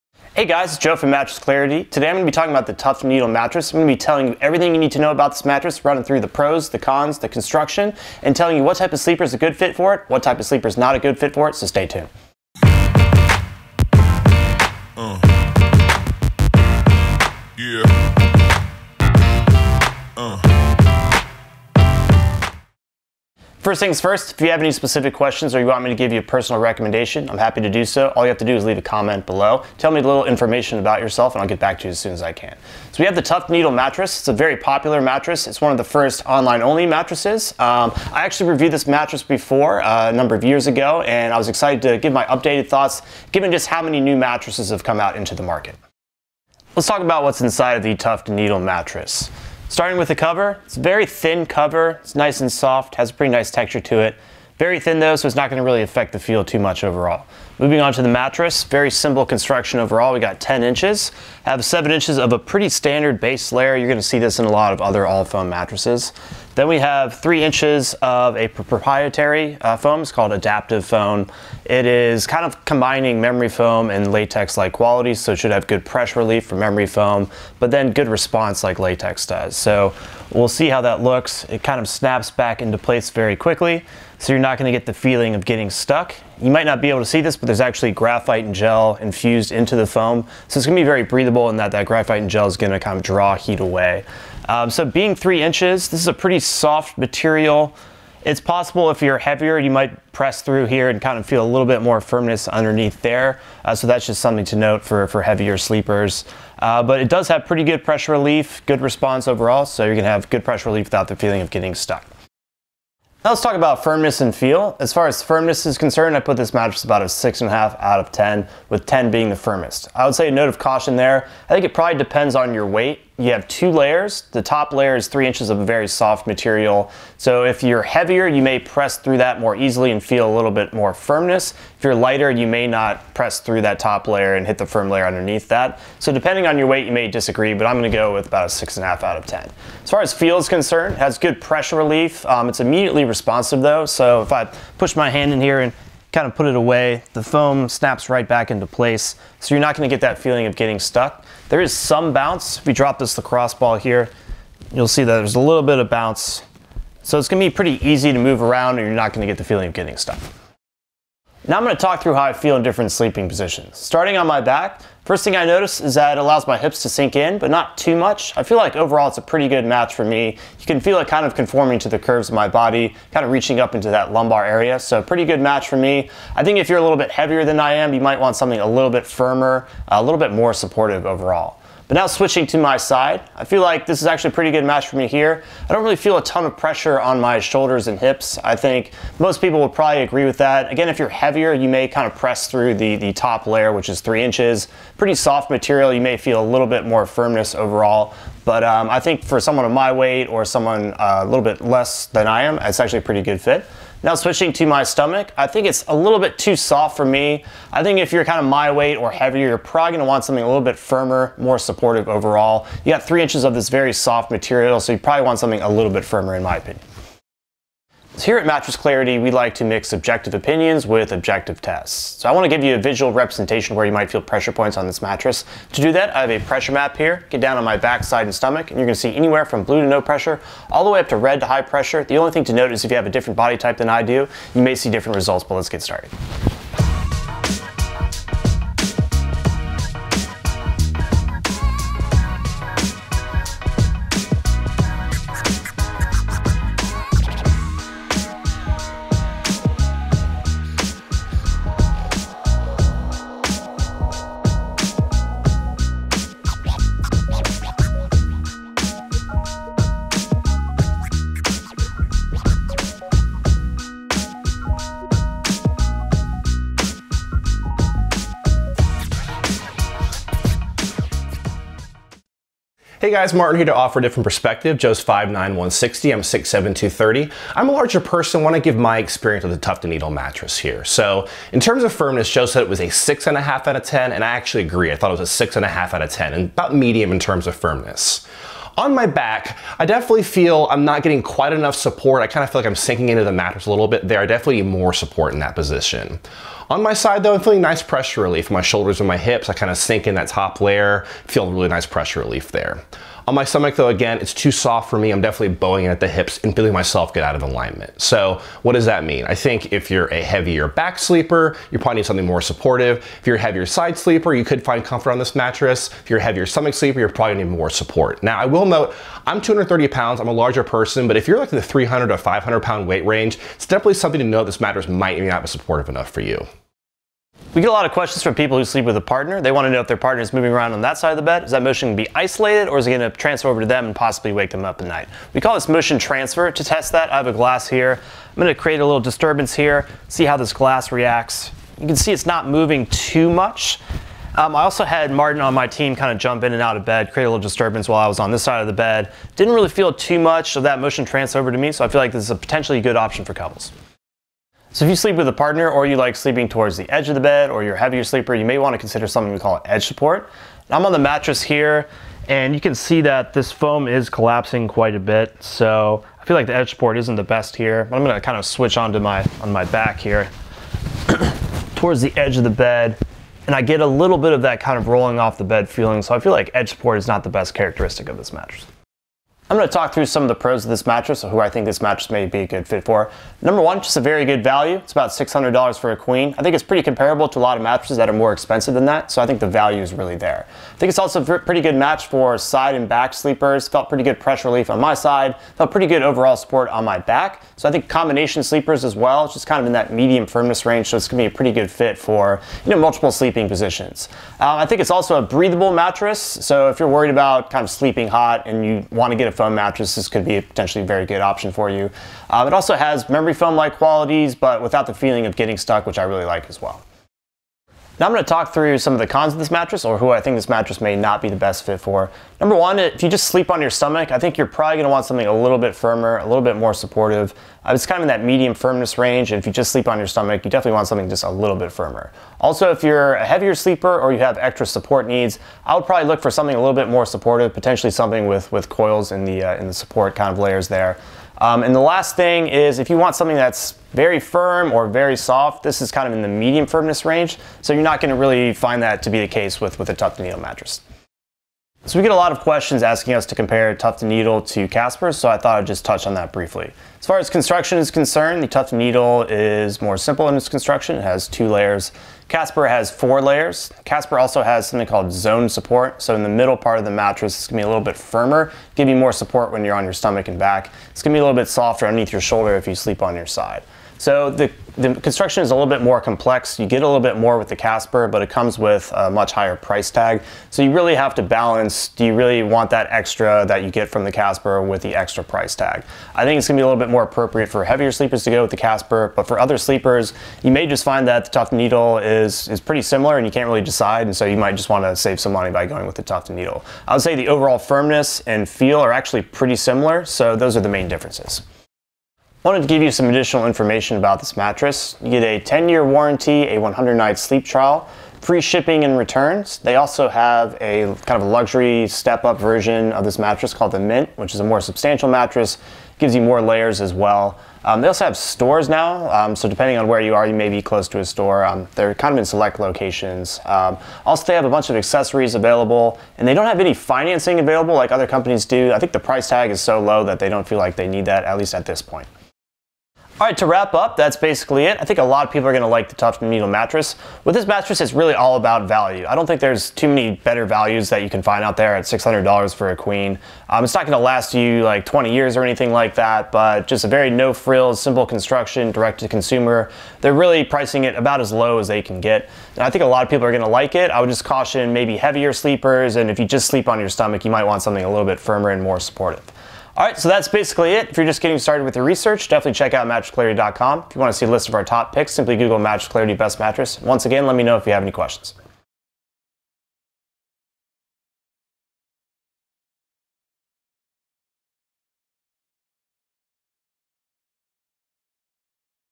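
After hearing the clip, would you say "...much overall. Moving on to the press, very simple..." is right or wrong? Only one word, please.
wrong.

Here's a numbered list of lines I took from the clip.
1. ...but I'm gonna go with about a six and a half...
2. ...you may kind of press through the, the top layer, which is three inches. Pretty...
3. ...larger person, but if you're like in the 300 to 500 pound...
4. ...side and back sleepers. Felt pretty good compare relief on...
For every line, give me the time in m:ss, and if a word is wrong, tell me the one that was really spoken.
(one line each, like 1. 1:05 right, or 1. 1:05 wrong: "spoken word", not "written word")
1. 2:17 right
2. 3:11 right
3. 5:20 right
4. 6:32 wrong: "pressure", not "compare".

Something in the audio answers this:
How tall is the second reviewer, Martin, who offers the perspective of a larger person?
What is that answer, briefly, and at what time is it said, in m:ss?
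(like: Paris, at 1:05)
6'7", at 4:36.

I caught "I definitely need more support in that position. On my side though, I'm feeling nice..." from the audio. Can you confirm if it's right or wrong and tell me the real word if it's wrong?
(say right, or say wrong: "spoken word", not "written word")
right.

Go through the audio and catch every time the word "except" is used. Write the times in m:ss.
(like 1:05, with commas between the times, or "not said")
not said.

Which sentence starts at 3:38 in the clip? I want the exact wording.
So here at Mattress Clarity, we like to mix subjective opinions with objective tests.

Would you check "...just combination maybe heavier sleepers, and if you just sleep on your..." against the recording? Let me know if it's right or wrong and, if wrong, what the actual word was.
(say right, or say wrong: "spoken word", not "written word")
wrong: "caution", not "combination".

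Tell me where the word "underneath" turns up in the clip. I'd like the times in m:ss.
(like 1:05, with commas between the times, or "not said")
1:42, 2:15, 7:51.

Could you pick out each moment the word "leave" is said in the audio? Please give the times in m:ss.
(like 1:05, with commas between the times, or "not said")
0:28.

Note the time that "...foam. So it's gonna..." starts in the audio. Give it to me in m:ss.
1:29.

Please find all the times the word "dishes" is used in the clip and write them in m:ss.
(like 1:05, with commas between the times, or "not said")
not said.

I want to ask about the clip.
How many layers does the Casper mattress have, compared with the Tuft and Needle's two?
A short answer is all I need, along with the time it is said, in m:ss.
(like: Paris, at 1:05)
4, at 7:42.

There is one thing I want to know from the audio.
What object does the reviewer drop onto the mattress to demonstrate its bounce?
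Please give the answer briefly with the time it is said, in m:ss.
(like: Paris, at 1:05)
lacrosse ball, at 2:33.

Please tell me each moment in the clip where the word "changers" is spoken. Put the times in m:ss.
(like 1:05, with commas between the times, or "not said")
not said.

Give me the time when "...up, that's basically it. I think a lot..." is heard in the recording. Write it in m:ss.
8:53.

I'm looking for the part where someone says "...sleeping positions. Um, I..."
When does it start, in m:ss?
6:43.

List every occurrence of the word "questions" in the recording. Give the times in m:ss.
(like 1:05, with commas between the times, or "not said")
0:25, 5:27, 7:32, 9:27.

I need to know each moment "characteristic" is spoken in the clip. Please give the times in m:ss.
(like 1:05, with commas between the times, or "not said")
6:17.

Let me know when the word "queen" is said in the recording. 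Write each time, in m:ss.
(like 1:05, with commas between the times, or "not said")
6:25, 9:02.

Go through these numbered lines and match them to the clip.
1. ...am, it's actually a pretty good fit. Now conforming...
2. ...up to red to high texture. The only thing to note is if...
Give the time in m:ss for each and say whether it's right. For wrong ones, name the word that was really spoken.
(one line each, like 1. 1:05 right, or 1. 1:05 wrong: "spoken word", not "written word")
1. 3:22 wrong: "switching", not "conforming"
2. 3:50 wrong: "pressure", not "texture".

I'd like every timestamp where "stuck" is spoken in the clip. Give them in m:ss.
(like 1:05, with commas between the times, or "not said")
1:25, 1:51, 2:30, 2:39, 6:55.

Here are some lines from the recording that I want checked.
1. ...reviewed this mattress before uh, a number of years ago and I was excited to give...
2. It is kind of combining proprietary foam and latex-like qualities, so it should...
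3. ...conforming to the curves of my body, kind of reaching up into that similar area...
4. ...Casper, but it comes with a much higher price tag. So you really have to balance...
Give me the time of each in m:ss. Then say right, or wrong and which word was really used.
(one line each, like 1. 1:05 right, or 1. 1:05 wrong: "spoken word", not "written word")
1. 0:38 right
2. 1:11 wrong: "memory", not "proprietary"
3. 2:51 wrong: "lumbar", not "similar"
4. 7:57 right.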